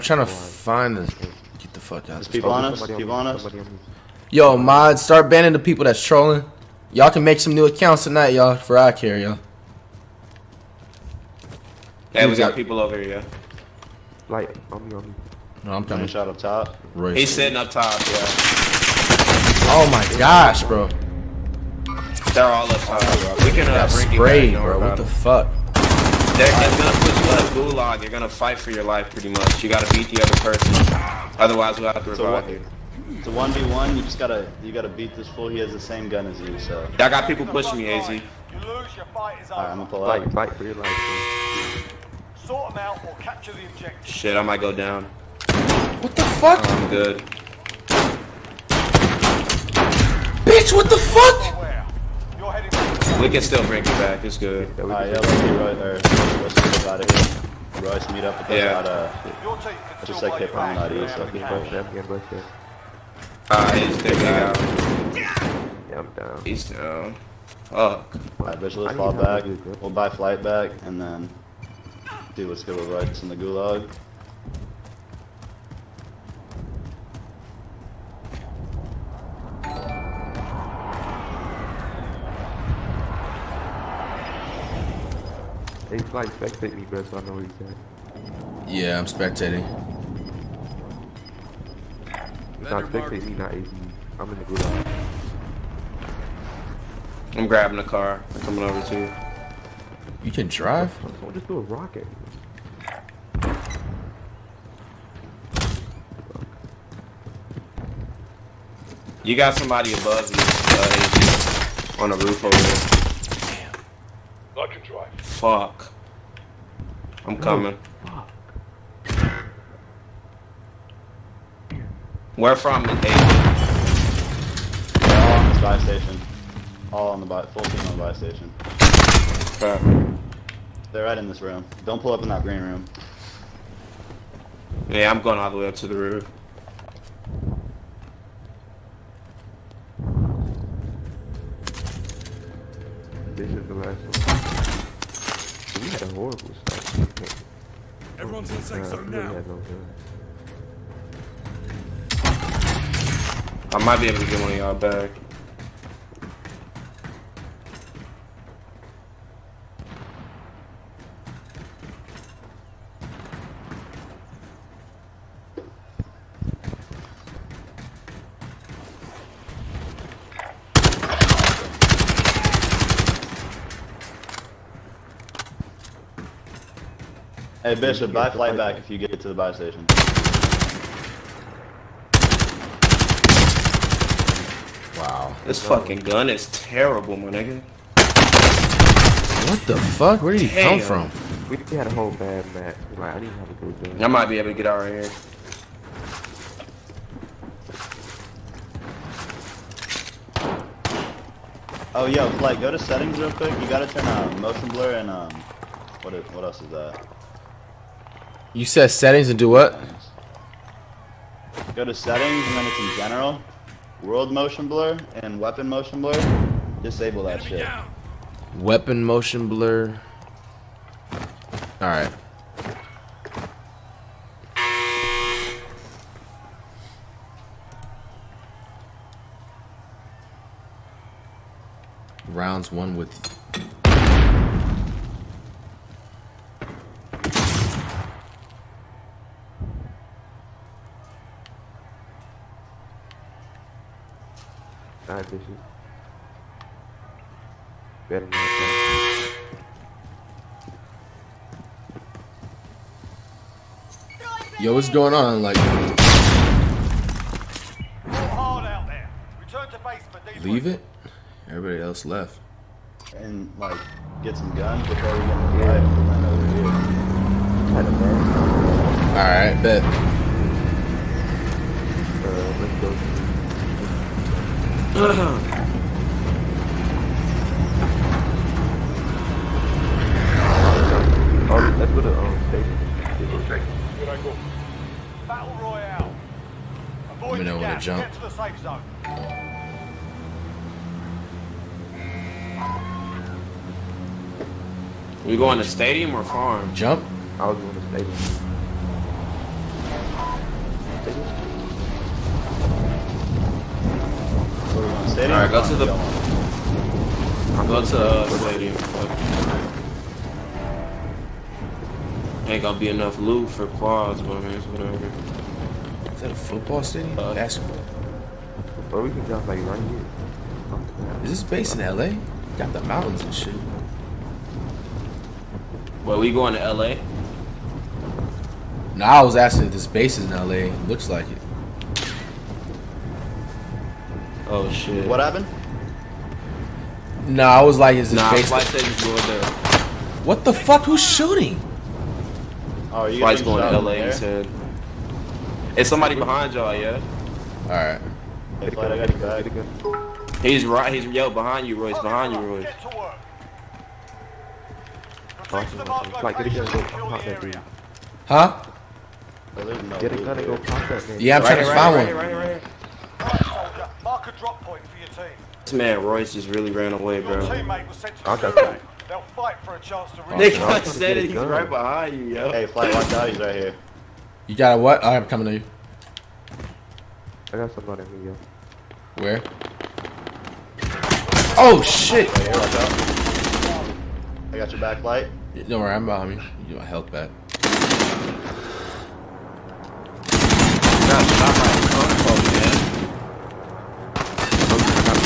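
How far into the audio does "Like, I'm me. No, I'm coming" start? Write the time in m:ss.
0:14.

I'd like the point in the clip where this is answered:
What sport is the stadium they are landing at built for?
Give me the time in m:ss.
5:17.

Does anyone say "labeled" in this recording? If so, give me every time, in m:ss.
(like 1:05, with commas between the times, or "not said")
not said.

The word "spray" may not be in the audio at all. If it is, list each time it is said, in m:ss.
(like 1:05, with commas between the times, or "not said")
0:24.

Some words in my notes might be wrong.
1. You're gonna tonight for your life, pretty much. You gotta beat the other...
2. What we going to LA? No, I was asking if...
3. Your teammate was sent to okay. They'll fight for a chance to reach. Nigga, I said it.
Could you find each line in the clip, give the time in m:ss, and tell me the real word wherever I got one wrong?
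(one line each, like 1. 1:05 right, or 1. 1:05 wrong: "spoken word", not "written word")
1. 0:28 wrong: "fight", not "tonight"
2. 5:26 right
3. 6:07 right.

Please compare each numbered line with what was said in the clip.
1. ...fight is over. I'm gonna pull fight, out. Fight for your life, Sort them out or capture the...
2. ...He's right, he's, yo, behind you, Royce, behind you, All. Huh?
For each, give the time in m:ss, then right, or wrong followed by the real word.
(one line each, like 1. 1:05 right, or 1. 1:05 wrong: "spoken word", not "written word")
1. 0:39 right
2. 5:50 wrong: "Royce", not "All".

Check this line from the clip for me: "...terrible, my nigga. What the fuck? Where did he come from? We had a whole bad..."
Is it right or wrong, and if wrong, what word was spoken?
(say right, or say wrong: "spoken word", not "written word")
right.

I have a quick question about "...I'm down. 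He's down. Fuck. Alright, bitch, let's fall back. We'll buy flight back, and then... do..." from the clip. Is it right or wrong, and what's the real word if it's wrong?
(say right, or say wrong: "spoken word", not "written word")
right.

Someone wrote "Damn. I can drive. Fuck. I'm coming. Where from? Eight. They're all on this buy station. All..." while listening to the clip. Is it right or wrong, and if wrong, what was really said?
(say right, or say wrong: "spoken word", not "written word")
right.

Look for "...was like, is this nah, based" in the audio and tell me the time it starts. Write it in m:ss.
5:37.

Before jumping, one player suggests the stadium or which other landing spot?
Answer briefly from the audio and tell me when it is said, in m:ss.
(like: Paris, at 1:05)
farm, at 4:56.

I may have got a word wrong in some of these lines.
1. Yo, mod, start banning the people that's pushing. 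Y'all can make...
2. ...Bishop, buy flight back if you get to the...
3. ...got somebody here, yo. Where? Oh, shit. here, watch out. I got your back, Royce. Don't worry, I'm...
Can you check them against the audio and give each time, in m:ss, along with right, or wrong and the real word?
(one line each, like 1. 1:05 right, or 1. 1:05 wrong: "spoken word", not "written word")
1. 0:04 wrong: "trolling", not "pushing"
2. 2:57 right
3. 6:17 wrong: "Light", not "Royce".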